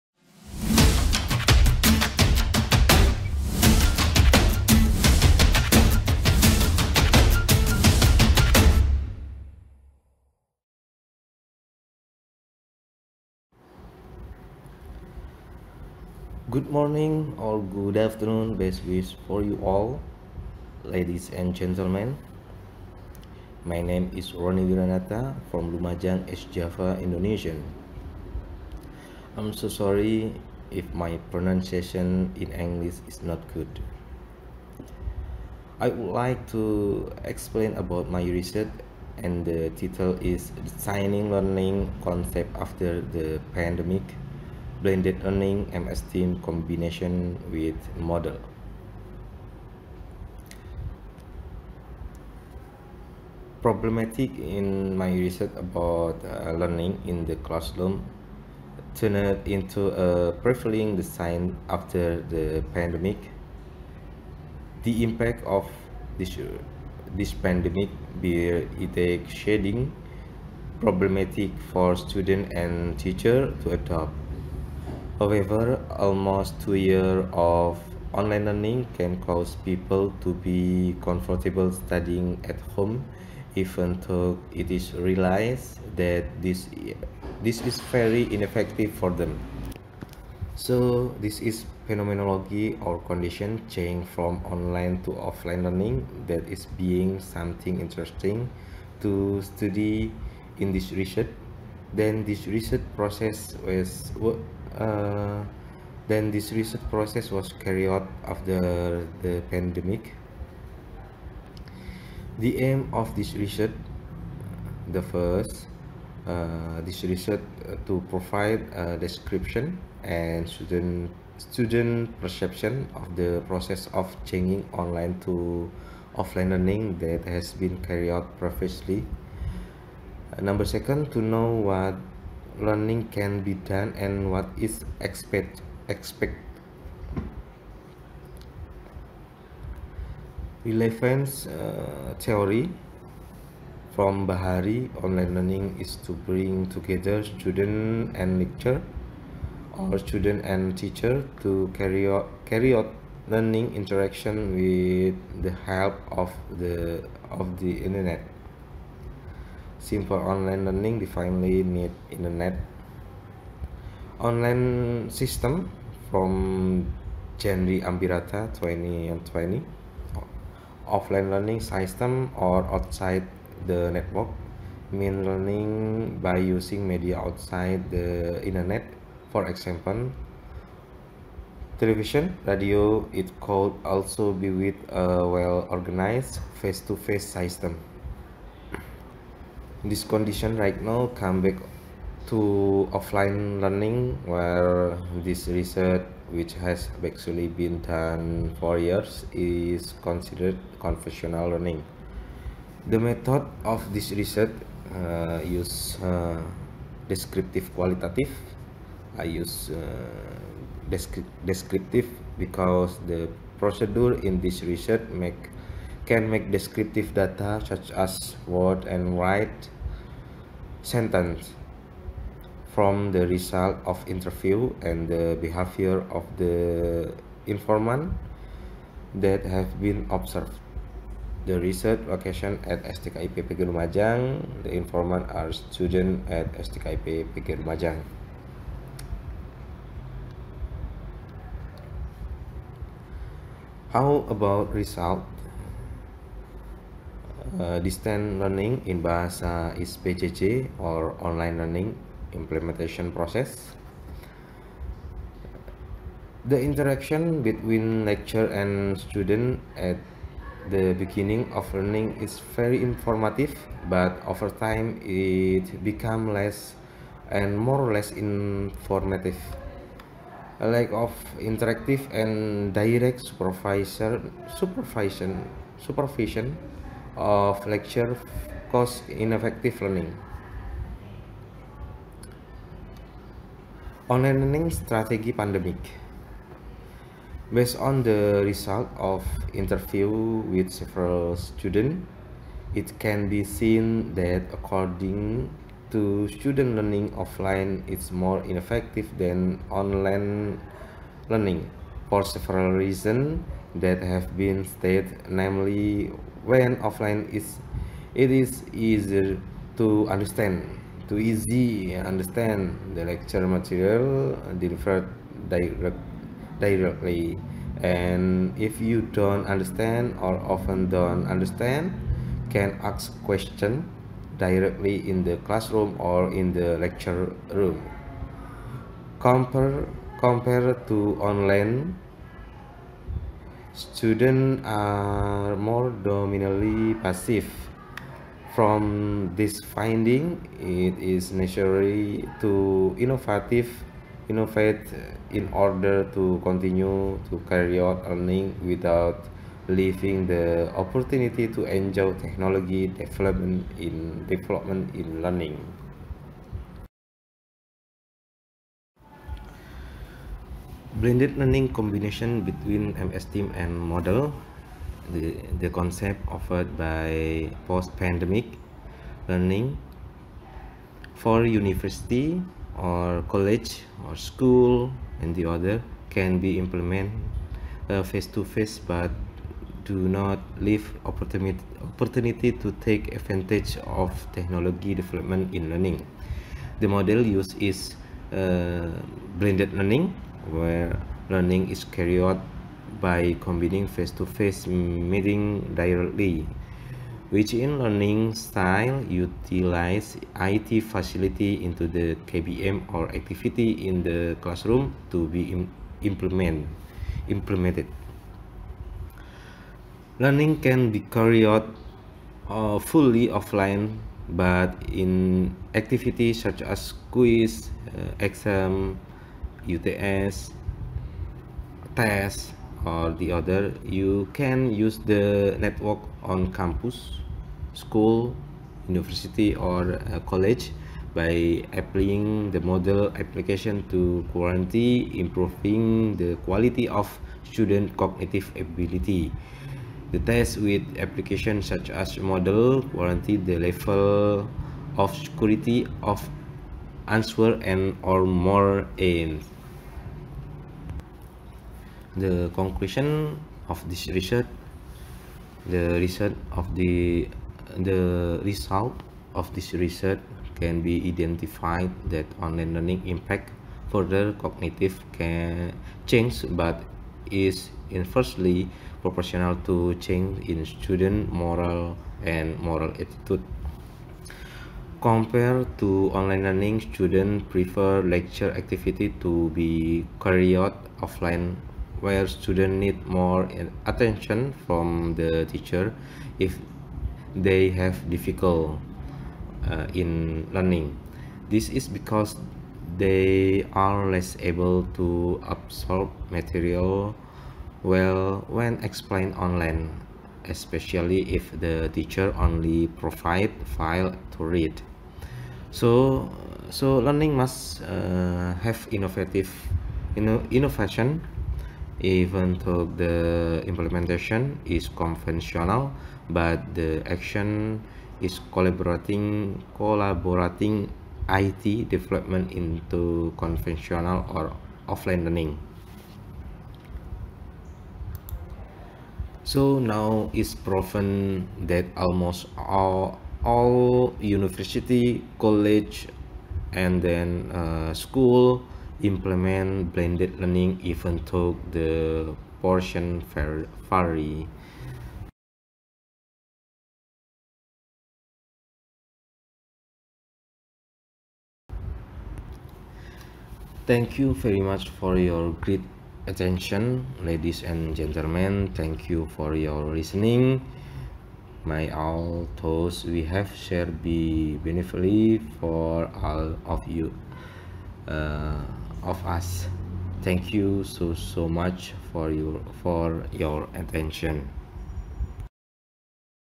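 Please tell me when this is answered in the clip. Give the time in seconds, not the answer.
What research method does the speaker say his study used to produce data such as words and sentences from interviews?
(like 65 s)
207 s.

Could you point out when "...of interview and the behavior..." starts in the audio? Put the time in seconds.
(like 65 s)
223 s.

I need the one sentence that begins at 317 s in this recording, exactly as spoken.
And if you don't understand or often don't understand, can ask question directly in the classroom or in the lecture room.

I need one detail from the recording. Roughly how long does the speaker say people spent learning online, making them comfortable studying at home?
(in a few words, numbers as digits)
almost two years.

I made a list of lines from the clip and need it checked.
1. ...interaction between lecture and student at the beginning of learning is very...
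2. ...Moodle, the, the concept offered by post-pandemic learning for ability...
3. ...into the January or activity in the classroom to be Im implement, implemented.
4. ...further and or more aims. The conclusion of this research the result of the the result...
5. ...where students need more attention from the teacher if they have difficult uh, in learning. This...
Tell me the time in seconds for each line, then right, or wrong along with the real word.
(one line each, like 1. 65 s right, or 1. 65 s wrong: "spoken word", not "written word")
1. 256 s right
2. 363 s wrong: "university", not "ability"
3. 401 s wrong: "KBM", not "January"
4. 447 s wrong: "answer", not "further"
5. 482 s right.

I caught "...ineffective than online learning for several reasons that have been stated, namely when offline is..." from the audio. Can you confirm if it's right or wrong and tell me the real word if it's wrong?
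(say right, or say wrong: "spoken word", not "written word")
right.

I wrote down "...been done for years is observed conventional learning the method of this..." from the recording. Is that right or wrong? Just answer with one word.
wrong.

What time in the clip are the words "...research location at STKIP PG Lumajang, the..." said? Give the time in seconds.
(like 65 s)
231 s.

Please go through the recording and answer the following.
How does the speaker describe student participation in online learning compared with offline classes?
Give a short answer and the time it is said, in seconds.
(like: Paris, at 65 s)
dominantly passive, at 336 s.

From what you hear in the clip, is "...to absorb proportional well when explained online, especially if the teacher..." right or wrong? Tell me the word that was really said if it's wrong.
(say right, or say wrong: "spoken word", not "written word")
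wrong: "material", not "proportional".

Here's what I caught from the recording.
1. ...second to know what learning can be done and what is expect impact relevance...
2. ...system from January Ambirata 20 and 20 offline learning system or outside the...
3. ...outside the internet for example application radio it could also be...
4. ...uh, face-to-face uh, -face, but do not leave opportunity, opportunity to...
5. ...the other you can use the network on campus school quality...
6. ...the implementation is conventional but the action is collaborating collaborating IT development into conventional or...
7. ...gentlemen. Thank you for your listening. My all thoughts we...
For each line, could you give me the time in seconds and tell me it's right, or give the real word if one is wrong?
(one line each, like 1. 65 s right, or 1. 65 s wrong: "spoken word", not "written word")
1. 130 s wrong: "expect", not "impact"
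2. 165 s right
3. 177 s wrong: "television", not "application"
4. 377 s right
5. 423 s wrong: "university", not "quality"
6. 512 s right
7. 557 s right.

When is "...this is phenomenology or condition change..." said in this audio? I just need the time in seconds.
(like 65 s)
91 s.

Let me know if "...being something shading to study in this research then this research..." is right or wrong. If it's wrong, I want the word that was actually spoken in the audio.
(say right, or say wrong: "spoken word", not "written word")
wrong: "interesting", not "shading".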